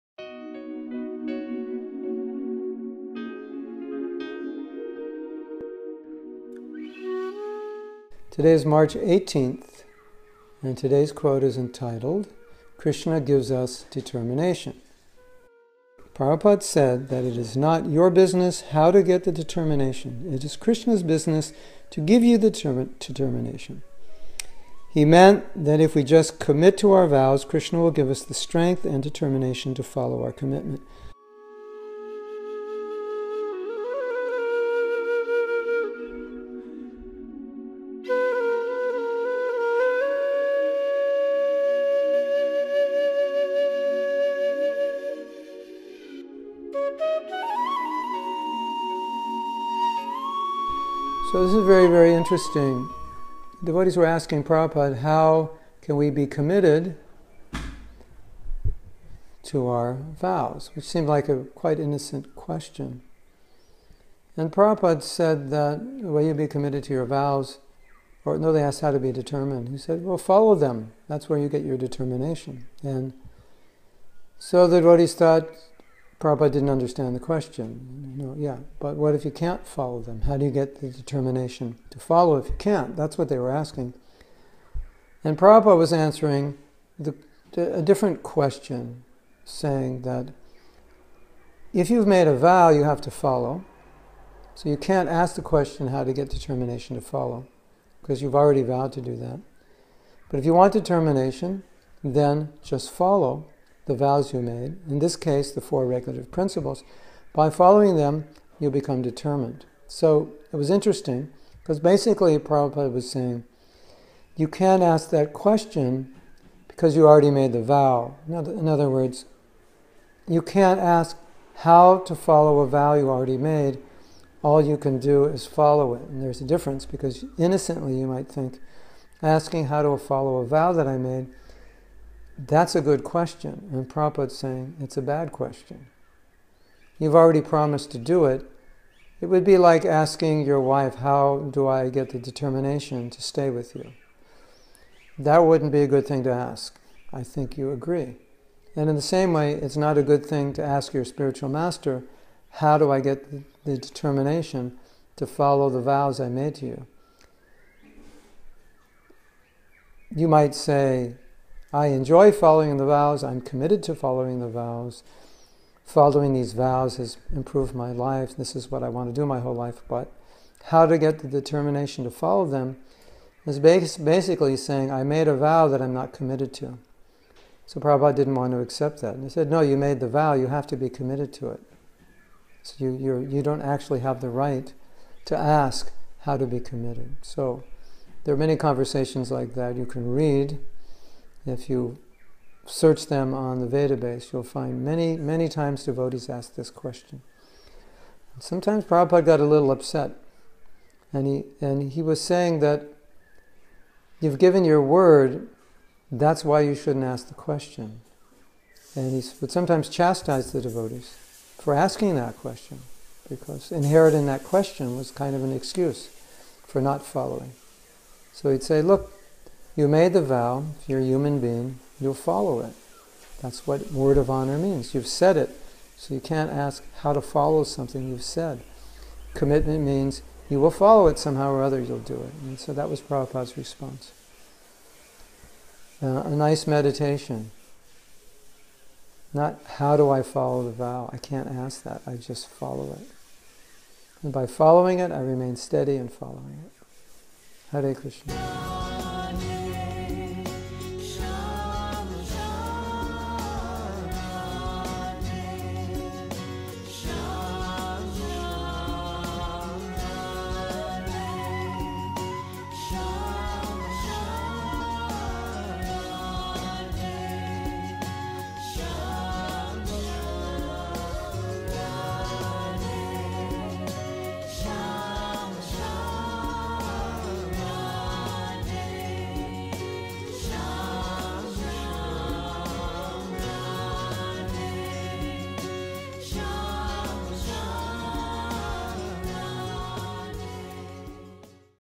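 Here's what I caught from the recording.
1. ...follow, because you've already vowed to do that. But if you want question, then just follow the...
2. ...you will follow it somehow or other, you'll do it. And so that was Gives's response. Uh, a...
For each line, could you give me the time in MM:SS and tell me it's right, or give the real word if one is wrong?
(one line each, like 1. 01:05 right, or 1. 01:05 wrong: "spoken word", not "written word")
1. 01:37 wrong: "determination", not "question"
2. 03:50 wrong: "Prabhupada", not "Gives".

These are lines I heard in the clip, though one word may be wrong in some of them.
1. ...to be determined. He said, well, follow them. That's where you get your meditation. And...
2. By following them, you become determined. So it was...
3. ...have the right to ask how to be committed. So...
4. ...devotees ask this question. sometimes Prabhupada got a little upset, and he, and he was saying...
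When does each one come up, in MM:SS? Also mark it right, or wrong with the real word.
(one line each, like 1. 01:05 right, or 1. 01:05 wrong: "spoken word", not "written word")
1. 01:08 wrong: "determination", not "meditation"
2. 01:47 right
3. 03:04 right
4. 03:15 right.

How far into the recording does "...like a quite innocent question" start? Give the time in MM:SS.
01:01.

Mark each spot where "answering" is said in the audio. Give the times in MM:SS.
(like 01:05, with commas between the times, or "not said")
01:25.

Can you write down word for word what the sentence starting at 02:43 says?
I'm committed to following the vows.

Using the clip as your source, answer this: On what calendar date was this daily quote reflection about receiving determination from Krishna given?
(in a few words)
March 18th.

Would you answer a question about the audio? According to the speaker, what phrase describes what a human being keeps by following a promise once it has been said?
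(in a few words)
word of honor.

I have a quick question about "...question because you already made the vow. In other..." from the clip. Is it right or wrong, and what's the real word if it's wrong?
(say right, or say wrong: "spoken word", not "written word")
right.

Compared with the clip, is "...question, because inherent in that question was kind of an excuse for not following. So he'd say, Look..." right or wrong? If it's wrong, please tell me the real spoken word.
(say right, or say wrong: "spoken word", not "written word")
right.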